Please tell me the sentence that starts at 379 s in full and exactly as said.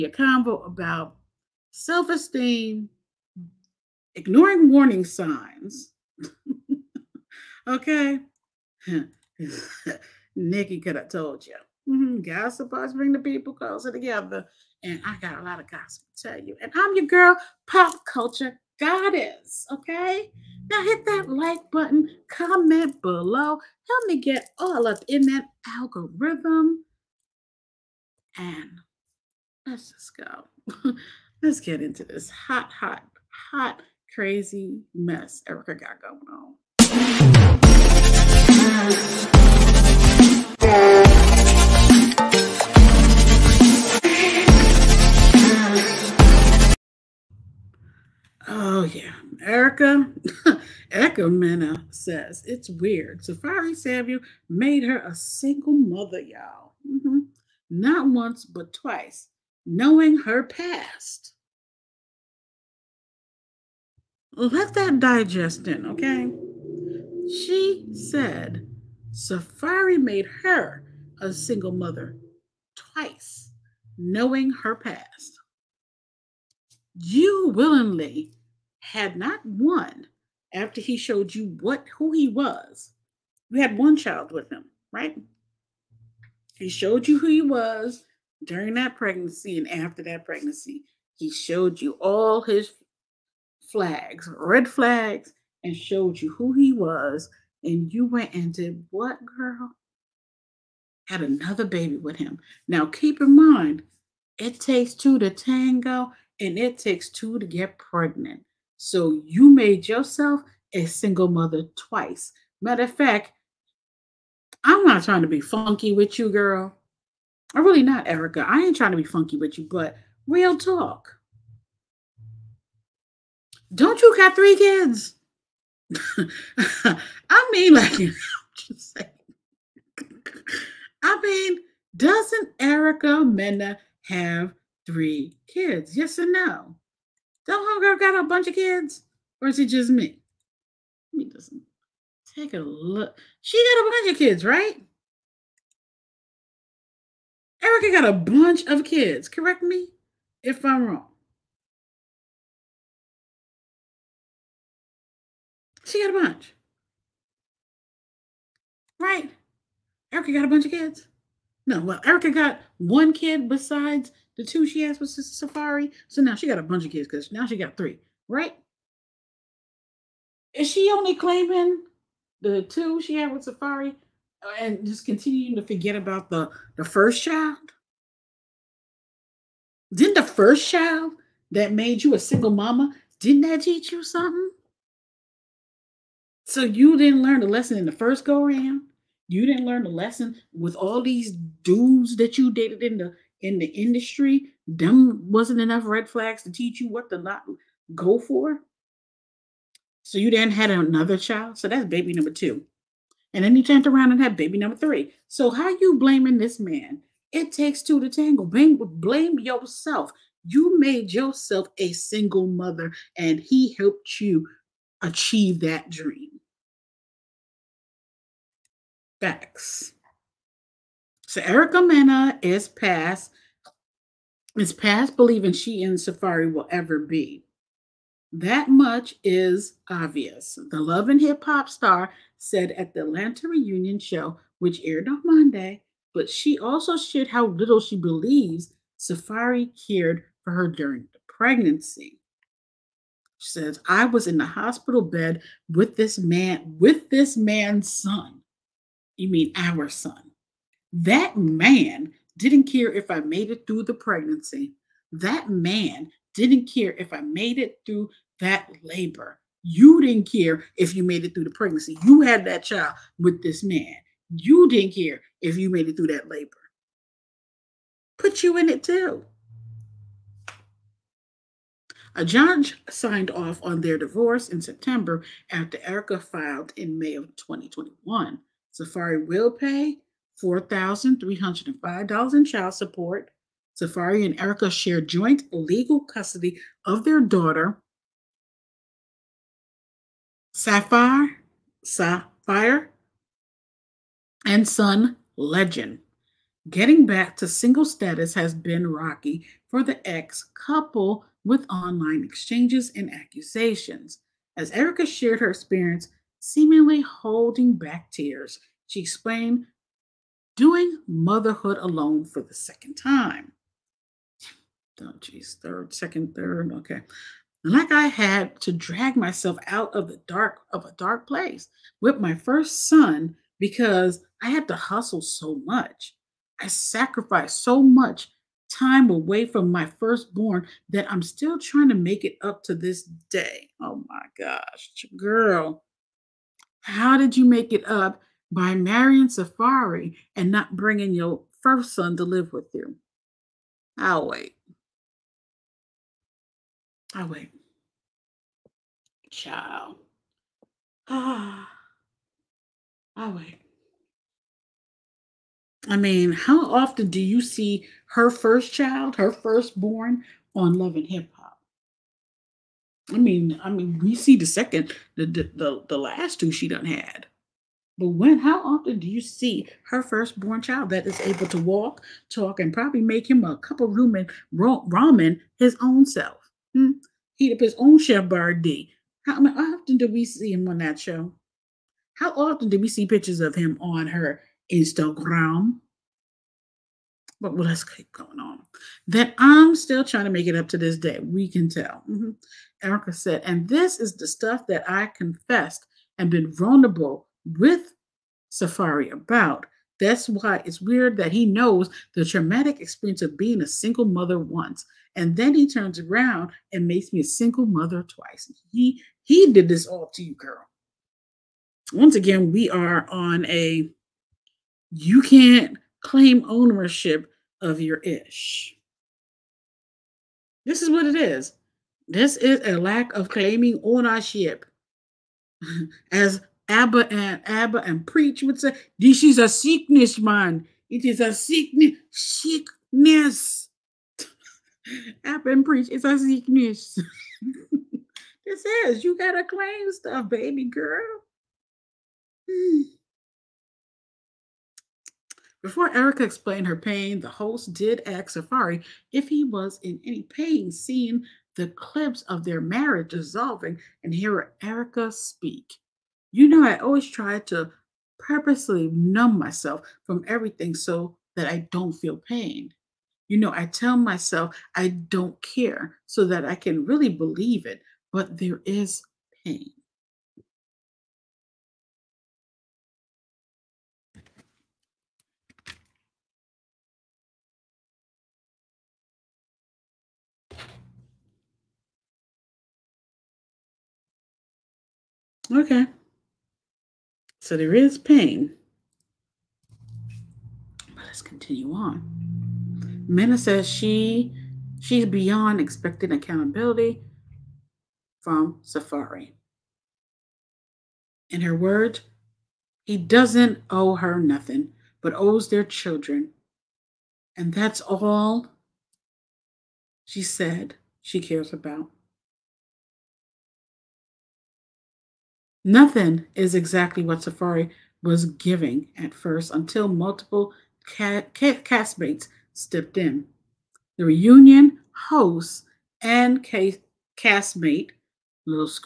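How, how often do we see him on that show?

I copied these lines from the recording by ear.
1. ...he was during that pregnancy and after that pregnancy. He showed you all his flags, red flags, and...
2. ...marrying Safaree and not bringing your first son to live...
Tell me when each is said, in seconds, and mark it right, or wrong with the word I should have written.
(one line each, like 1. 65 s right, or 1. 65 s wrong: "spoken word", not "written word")
1. 87 s right
2. 338 s right.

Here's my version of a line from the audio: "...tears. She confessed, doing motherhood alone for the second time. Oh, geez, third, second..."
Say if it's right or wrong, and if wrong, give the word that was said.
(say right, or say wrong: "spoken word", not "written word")
wrong: "explained", not "confessed".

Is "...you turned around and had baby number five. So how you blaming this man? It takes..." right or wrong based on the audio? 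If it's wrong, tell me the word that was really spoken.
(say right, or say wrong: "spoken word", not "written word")
wrong: "three", not "five".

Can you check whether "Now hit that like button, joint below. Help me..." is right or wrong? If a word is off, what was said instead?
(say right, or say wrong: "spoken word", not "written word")
wrong: "comment", not "joint".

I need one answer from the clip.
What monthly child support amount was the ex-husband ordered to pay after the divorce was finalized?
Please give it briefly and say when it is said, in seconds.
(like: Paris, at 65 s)
$4,305, at 280 s.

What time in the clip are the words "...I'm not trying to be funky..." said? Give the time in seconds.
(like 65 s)
114 s.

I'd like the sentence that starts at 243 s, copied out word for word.
She says, I was in the hospital bed with this man, with this man's son.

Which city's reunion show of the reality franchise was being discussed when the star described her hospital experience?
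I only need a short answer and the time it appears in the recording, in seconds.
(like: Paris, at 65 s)
Atlanta, at 233 s.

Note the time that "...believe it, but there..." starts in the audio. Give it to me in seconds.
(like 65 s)
467 s.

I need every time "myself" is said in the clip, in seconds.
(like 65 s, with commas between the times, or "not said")
319 s, 459 s, 463 s.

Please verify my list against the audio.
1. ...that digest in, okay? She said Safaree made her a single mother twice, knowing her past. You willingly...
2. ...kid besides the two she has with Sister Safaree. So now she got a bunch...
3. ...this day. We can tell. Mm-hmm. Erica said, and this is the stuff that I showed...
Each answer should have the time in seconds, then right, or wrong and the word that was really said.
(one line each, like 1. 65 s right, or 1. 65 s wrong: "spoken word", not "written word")
1. 64 s right
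2. 163 s right
3. 390 s wrong: "confessed", not "showed".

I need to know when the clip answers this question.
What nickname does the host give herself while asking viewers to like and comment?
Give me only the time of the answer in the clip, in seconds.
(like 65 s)
17 s.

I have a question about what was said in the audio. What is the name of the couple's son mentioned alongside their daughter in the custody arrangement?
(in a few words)
Legend.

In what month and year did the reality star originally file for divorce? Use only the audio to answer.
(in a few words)
May 2021.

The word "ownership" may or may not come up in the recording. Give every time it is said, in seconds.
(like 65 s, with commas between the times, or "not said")
416 s, 423 s.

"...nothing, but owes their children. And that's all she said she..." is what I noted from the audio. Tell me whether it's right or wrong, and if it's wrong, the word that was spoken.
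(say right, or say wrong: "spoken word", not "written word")
right.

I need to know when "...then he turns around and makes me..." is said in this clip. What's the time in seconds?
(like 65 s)
405 s.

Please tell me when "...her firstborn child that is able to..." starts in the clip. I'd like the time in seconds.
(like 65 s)
369 s.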